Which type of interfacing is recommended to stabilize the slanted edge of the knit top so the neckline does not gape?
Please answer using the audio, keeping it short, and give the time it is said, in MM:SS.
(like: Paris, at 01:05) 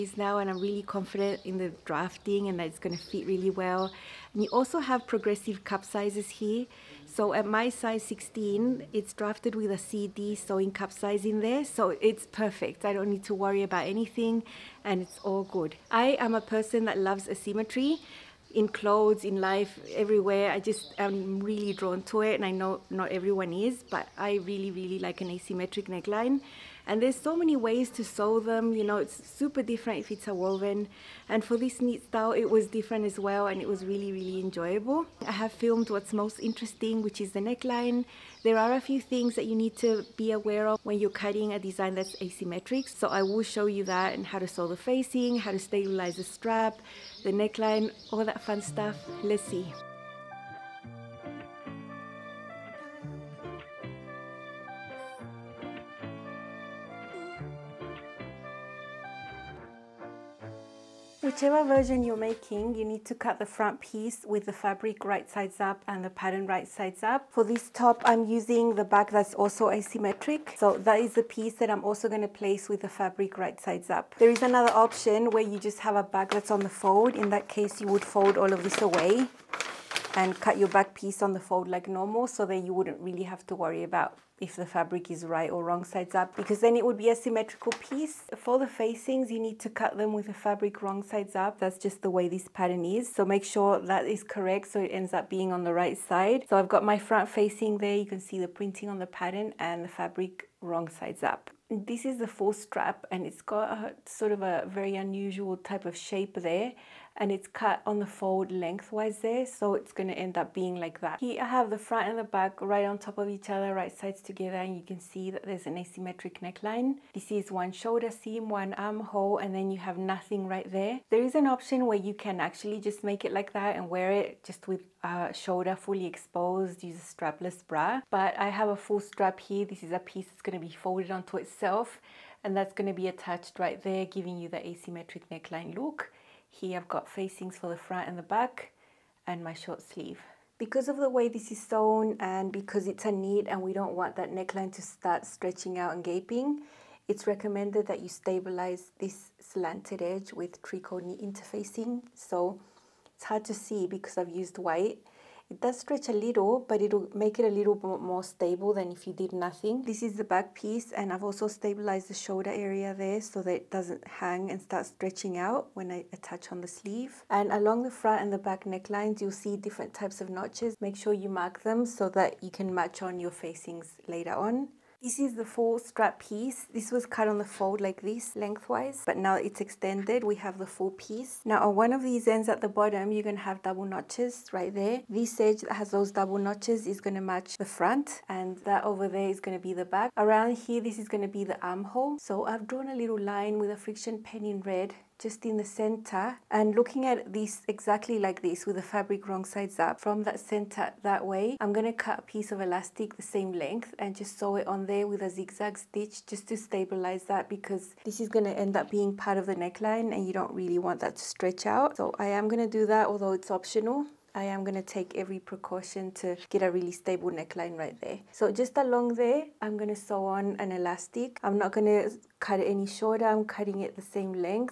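tricot knit interfacing, at 02:30.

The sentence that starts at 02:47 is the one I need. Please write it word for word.
And along the front and the back necklines, you'll see different types of notches.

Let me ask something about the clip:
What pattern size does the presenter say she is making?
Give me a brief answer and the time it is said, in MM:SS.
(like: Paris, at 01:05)
16, at 00:07.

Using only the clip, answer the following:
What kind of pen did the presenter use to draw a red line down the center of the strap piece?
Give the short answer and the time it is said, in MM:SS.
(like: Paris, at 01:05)
friction pen, at 03:13.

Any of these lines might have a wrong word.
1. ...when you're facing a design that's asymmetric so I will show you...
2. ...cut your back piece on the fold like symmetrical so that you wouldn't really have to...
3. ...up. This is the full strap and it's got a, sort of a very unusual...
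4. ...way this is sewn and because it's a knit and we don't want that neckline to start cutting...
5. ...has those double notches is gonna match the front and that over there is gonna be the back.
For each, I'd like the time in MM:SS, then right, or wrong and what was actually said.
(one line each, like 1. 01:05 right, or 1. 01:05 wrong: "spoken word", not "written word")
1. 00:40 wrong: "cutting", not "facing"
2. 01:20 wrong: "normal", not "symmetrical"
3. 01:41 right
4. 02:21 wrong: "stretching", not "cutting"
5. 03:05 right.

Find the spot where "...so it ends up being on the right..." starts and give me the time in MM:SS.
01:34.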